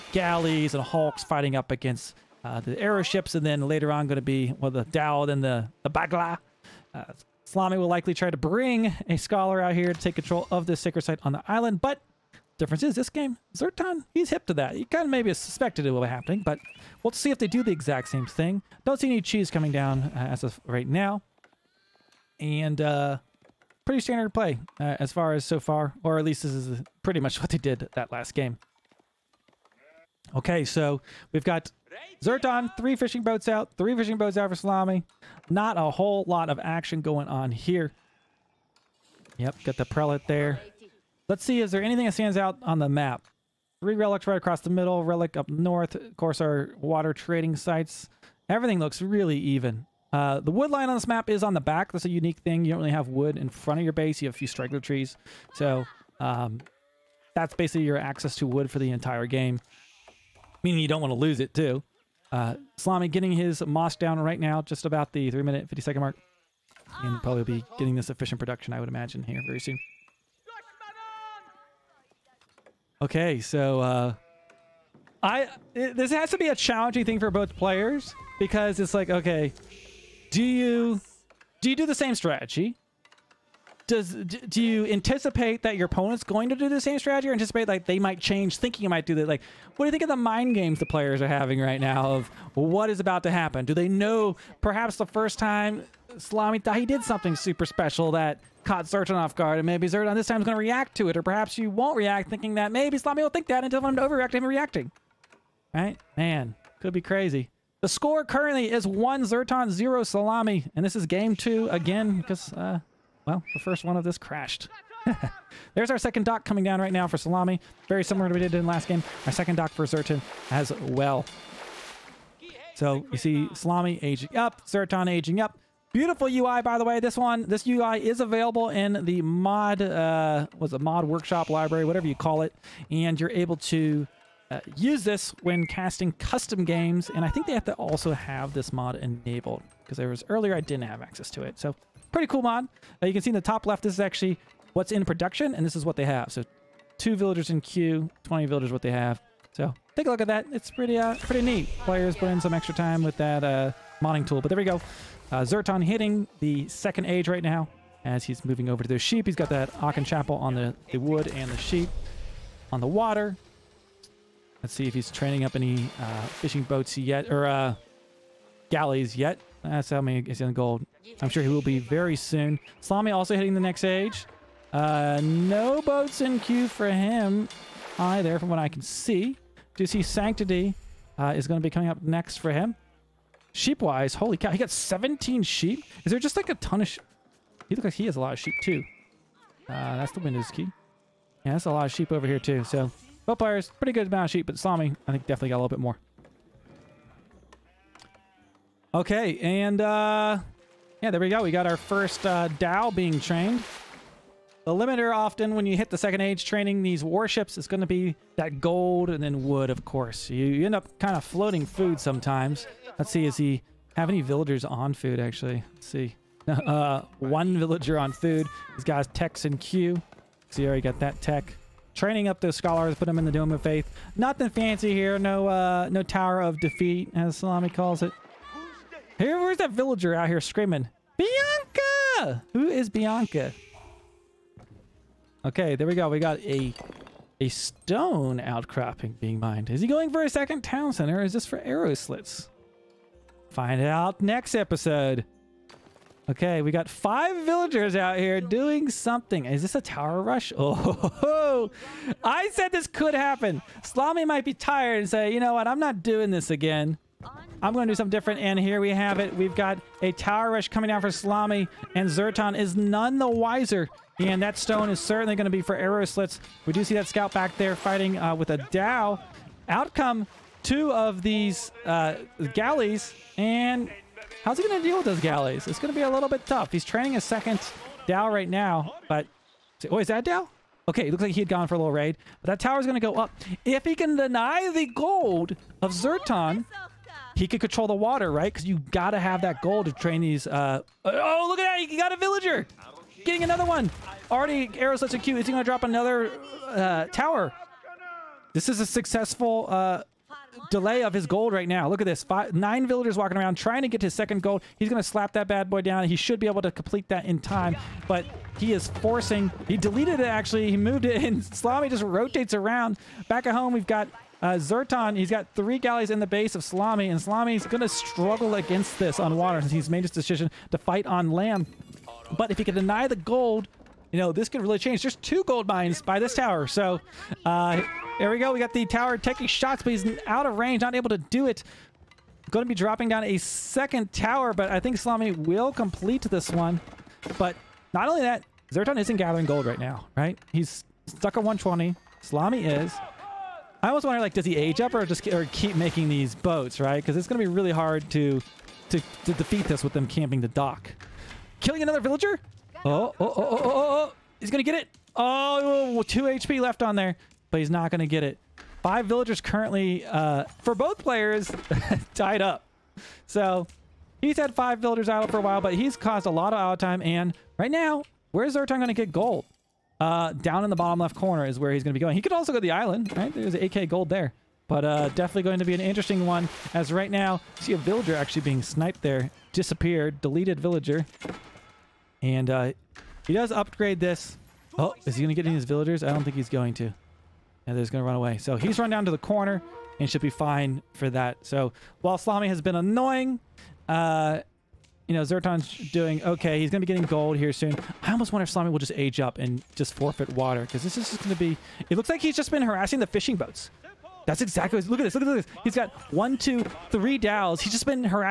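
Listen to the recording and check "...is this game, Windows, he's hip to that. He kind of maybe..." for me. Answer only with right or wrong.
wrong.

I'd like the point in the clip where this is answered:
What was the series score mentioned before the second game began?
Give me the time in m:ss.
1:48.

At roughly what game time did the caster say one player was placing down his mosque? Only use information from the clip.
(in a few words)
3 minutes 50 seconds.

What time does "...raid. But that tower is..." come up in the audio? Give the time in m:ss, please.
4:41.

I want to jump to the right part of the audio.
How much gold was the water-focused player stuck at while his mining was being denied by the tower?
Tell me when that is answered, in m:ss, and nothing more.
5:41.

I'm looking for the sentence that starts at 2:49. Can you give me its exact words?
That's how many is in gold.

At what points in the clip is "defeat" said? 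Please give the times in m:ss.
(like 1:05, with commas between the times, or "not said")
3:46, 5:49.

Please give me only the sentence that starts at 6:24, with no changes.
Oh, is he going to get any of his villagers?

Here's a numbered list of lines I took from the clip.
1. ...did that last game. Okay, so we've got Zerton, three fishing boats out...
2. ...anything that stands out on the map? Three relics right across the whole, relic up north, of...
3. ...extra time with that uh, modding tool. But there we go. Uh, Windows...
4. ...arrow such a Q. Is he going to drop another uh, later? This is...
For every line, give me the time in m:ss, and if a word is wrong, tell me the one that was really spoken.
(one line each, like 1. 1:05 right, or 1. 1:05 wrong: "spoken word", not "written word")
1. 0:27 right
2. 0:41 wrong: "middle", not "whole"
3. 2:32 wrong: "Zerton", not "Windows"
4. 4:54 wrong: "tower", not "later".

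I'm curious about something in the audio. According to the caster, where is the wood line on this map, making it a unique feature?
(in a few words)
On the back.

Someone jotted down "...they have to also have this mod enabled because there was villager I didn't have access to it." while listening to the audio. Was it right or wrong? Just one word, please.
wrong.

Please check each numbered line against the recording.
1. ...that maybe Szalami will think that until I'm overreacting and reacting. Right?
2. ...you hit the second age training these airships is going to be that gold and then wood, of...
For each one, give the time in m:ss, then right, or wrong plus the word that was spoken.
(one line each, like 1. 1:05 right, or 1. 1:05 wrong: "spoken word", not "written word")
1. 1:42 right
2. 3:25 wrong: "warships", not "airships".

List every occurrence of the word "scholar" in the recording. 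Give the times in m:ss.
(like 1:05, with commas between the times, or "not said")
0:09, 3:42.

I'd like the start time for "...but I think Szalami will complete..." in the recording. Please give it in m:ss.
5:34.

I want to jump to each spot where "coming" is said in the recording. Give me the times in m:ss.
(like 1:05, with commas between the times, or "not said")
0:19, 1:56, 3:01, 4:20.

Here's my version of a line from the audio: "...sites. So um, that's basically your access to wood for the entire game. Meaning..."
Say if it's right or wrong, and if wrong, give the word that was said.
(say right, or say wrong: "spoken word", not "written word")
wrong: "trees", not "sites".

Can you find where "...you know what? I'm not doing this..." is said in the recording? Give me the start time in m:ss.
4:15.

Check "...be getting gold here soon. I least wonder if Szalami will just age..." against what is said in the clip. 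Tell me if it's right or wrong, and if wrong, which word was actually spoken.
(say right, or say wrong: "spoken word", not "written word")
wrong: "almost", not "least".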